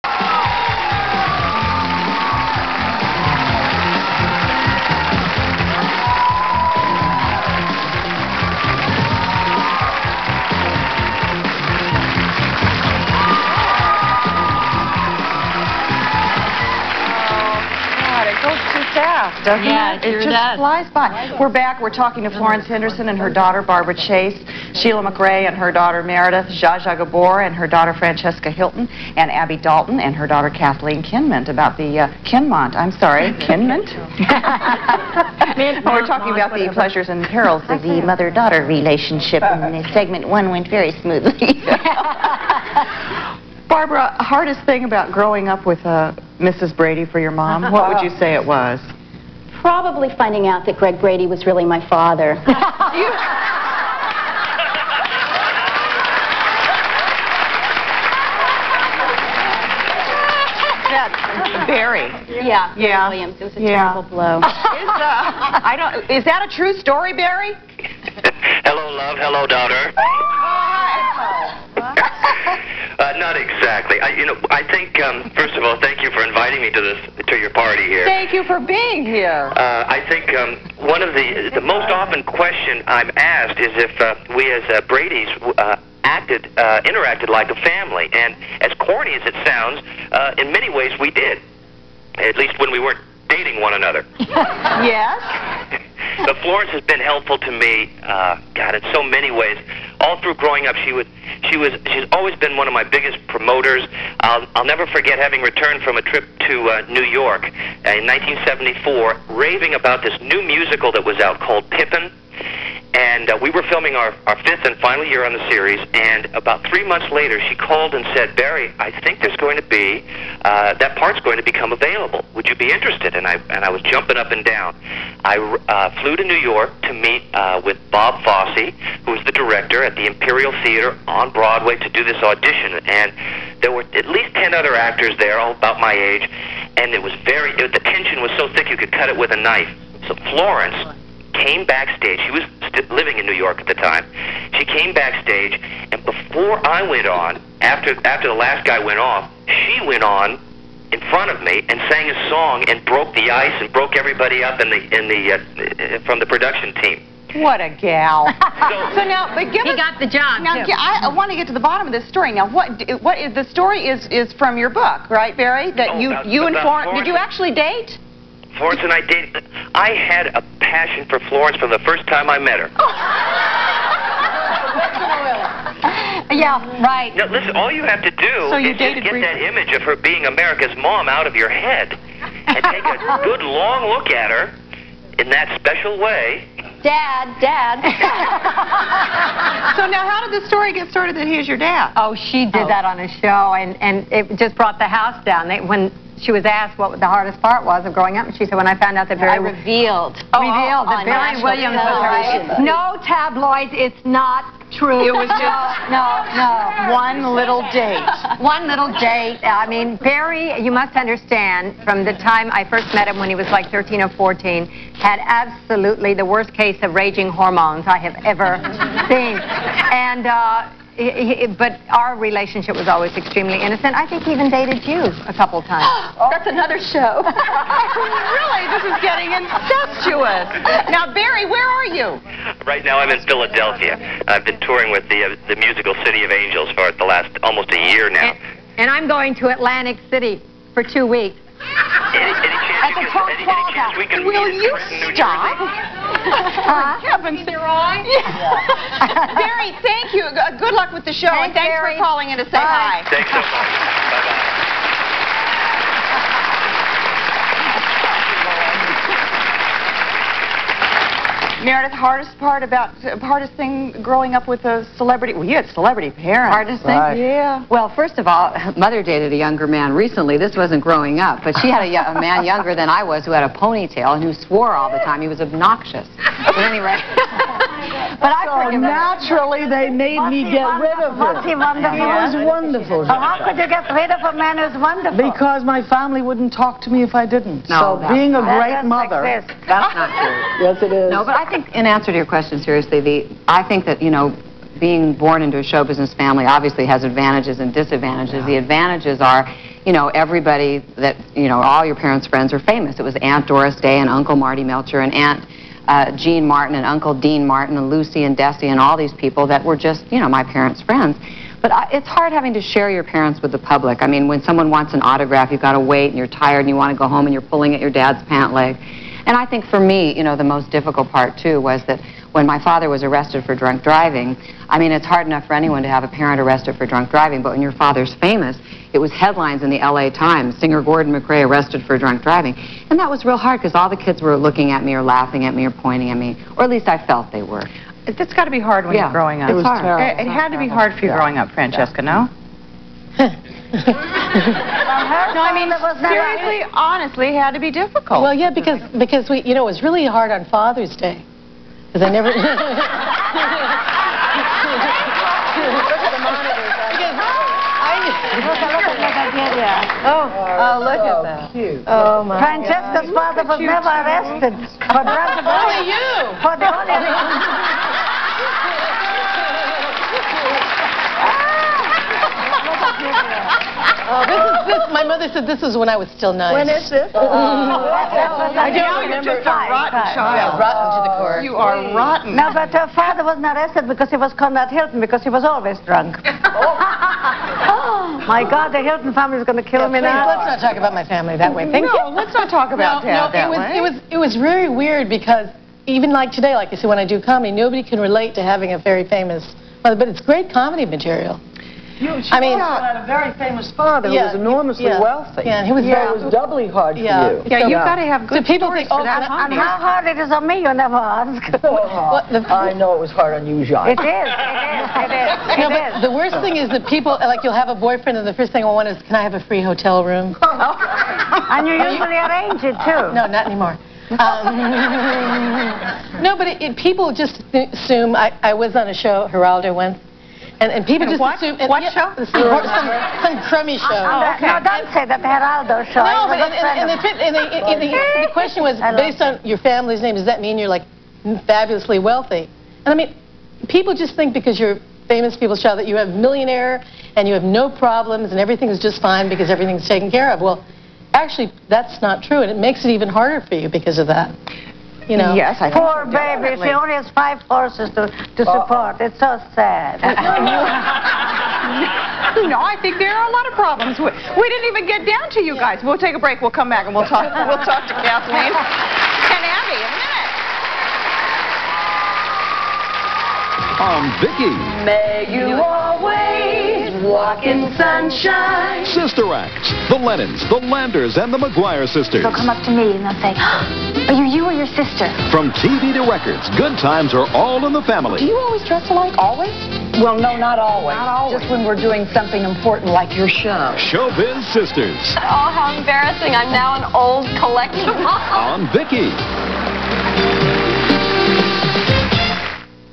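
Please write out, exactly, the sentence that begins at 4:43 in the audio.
how could you get rid of a man who's wonderful?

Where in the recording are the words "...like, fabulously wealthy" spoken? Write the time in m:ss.
7:20.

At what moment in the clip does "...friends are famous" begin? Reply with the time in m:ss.
5:02.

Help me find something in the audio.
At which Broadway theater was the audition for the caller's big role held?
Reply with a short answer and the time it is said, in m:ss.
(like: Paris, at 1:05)
Imperial Theater, at 2:10.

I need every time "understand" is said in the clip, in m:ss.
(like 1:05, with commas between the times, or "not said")
3:30.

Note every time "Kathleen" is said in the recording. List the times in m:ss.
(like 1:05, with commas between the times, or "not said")
0:30, 7:48.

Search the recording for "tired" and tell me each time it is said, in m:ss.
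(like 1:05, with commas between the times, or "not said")
5:16.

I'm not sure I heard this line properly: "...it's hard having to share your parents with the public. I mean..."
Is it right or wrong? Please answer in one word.
right.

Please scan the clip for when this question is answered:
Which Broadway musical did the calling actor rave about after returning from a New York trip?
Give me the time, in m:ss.
1:51.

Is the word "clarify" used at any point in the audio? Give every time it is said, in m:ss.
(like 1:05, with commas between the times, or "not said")
not said.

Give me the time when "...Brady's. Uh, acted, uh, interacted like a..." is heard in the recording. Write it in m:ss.
1:24.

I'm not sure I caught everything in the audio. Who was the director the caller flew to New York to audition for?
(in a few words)
Bob Fosse.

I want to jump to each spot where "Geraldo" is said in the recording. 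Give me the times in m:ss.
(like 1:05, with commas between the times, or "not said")
7:09, 7:15.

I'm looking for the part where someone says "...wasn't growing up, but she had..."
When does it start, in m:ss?
4:30.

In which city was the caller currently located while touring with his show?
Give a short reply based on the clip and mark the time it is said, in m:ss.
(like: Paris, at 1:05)
Philadelphia, at 3:53.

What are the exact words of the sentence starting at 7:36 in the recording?
She only has five horses to, to support.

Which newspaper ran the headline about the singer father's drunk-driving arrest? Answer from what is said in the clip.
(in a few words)
LA Times.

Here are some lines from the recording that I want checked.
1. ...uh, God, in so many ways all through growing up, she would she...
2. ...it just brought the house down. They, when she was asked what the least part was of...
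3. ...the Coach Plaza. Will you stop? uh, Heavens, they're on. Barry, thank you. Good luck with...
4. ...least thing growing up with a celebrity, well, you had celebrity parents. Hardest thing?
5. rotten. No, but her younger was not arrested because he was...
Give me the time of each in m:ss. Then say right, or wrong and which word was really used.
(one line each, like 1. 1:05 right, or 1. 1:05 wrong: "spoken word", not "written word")
1. 1:38 right
2. 3:14 wrong: "hardest", not "least"
3. 4:02 right
4. 4:23 wrong: "hardest", not "least"
5. 6:21 wrong: "father", not "younger".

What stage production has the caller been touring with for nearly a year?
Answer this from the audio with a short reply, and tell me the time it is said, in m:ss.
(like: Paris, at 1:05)
City of Angels, at 3:56.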